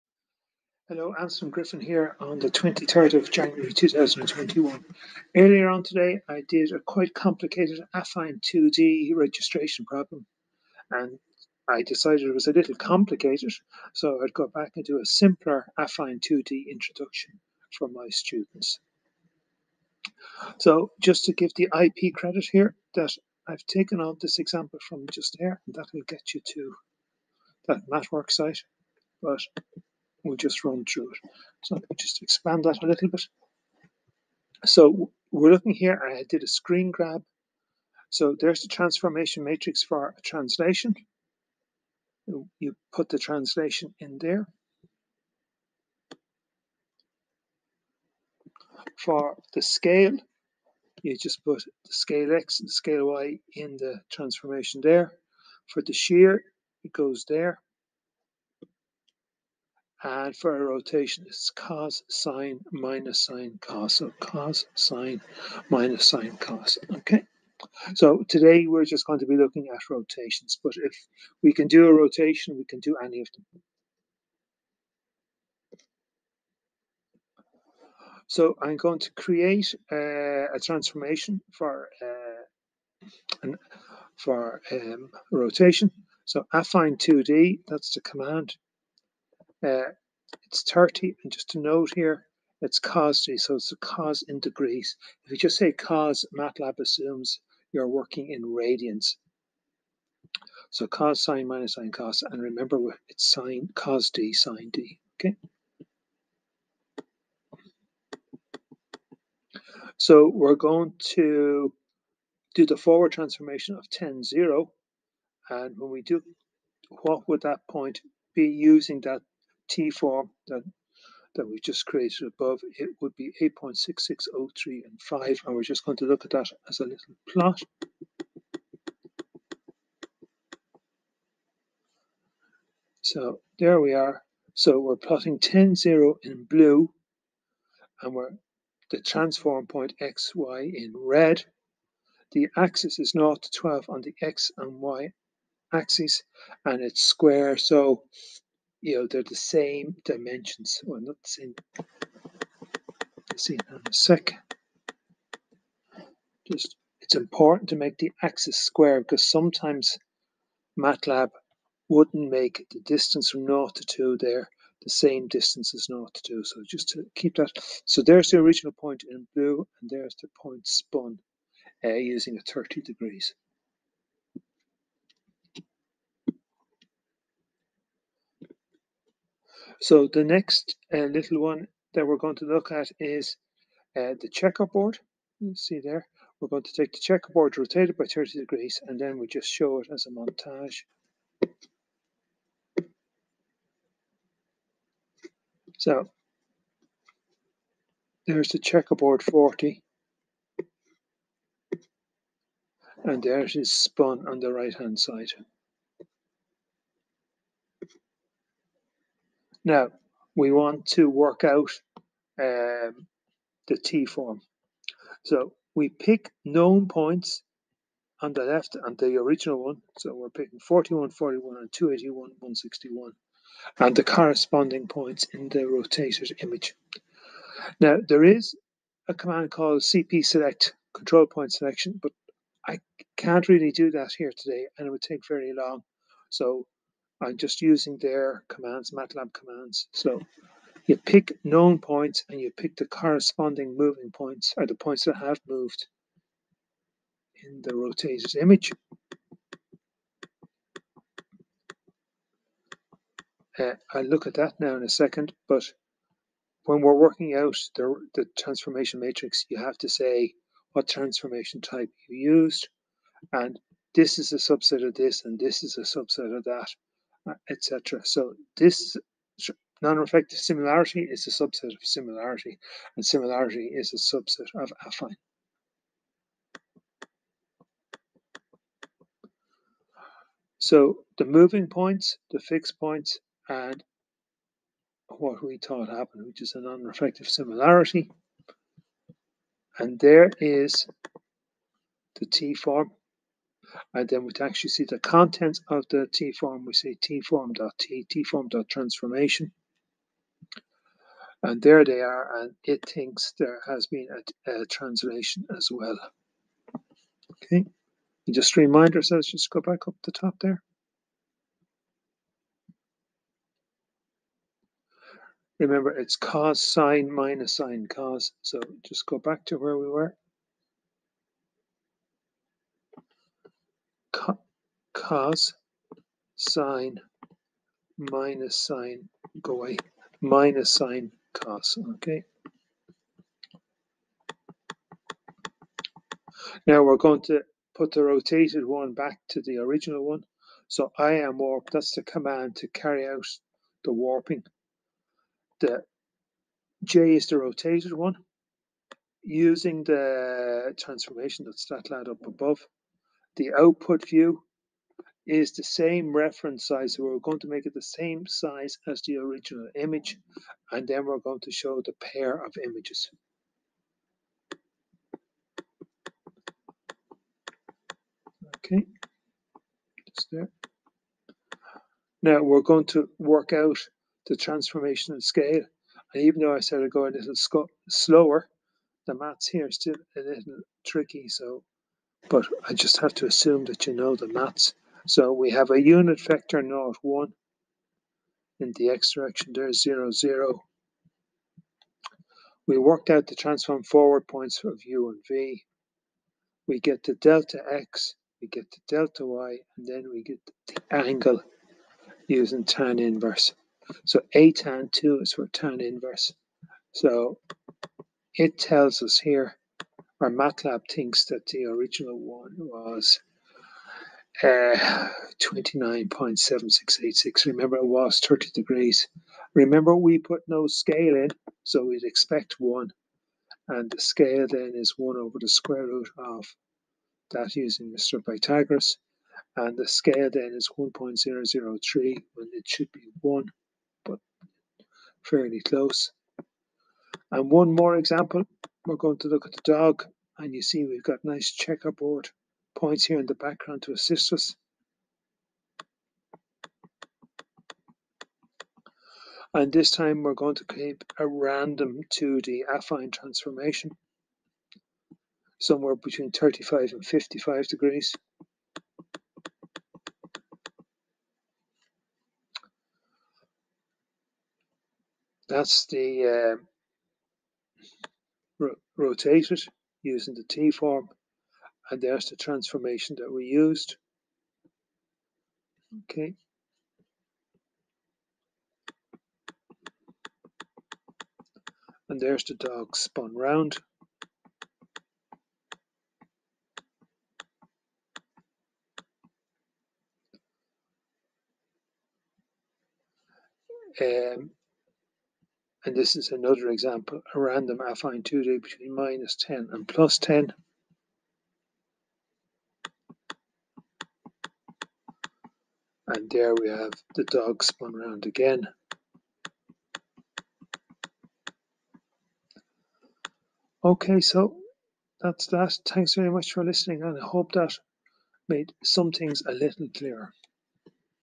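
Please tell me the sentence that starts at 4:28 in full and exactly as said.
So this non-reflective similarity is a subset of similarity, and similarity is a subset of affine.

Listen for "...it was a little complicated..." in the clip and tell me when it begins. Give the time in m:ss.
0:12.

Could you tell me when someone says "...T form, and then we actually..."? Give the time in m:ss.
4:52.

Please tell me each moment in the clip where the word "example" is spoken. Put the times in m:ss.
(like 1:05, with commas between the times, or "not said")
0:24, 7:17, 8:16.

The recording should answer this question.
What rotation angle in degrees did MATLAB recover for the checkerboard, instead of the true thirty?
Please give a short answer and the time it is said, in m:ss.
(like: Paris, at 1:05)
29.7686, at 6:55.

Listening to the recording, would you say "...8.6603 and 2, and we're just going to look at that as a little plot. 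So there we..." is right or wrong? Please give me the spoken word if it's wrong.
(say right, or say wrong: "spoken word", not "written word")
wrong: "5", not "2".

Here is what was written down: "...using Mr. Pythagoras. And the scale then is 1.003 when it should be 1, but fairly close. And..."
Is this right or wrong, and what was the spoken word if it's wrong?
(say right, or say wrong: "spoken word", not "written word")
right.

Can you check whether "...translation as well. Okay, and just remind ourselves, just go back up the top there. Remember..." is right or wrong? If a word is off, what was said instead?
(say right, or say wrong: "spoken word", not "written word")
right.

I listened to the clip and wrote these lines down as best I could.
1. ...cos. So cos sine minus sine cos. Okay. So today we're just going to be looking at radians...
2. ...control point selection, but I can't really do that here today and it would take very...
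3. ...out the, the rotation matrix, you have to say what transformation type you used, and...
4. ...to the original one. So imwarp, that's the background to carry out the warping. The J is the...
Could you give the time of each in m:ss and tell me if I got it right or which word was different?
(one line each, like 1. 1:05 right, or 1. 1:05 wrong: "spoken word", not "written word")
1. 1:03 wrong: "rotations", not "radians"
2. 3:50 right
3. 4:17 wrong: "transformation", not "rotation"
4. 5:39 wrong: "command", not "background".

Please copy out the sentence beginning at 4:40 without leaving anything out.
So the moving points, the fixed points, and what we thought happened, which is a non-reflective similarity.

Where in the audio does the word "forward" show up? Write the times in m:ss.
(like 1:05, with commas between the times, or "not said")
1:52, 6:33.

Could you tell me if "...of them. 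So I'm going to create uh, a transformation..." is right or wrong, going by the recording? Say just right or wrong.
right.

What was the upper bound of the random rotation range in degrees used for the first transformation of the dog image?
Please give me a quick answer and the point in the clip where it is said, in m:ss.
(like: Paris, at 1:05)
55, at 7:37.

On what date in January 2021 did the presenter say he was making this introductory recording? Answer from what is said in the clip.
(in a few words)
23rd.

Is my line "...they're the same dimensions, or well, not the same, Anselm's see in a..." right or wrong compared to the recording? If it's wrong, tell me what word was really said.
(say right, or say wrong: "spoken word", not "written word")
wrong: "Let", not "Anselm".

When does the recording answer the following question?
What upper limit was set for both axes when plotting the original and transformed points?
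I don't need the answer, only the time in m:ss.
2:23.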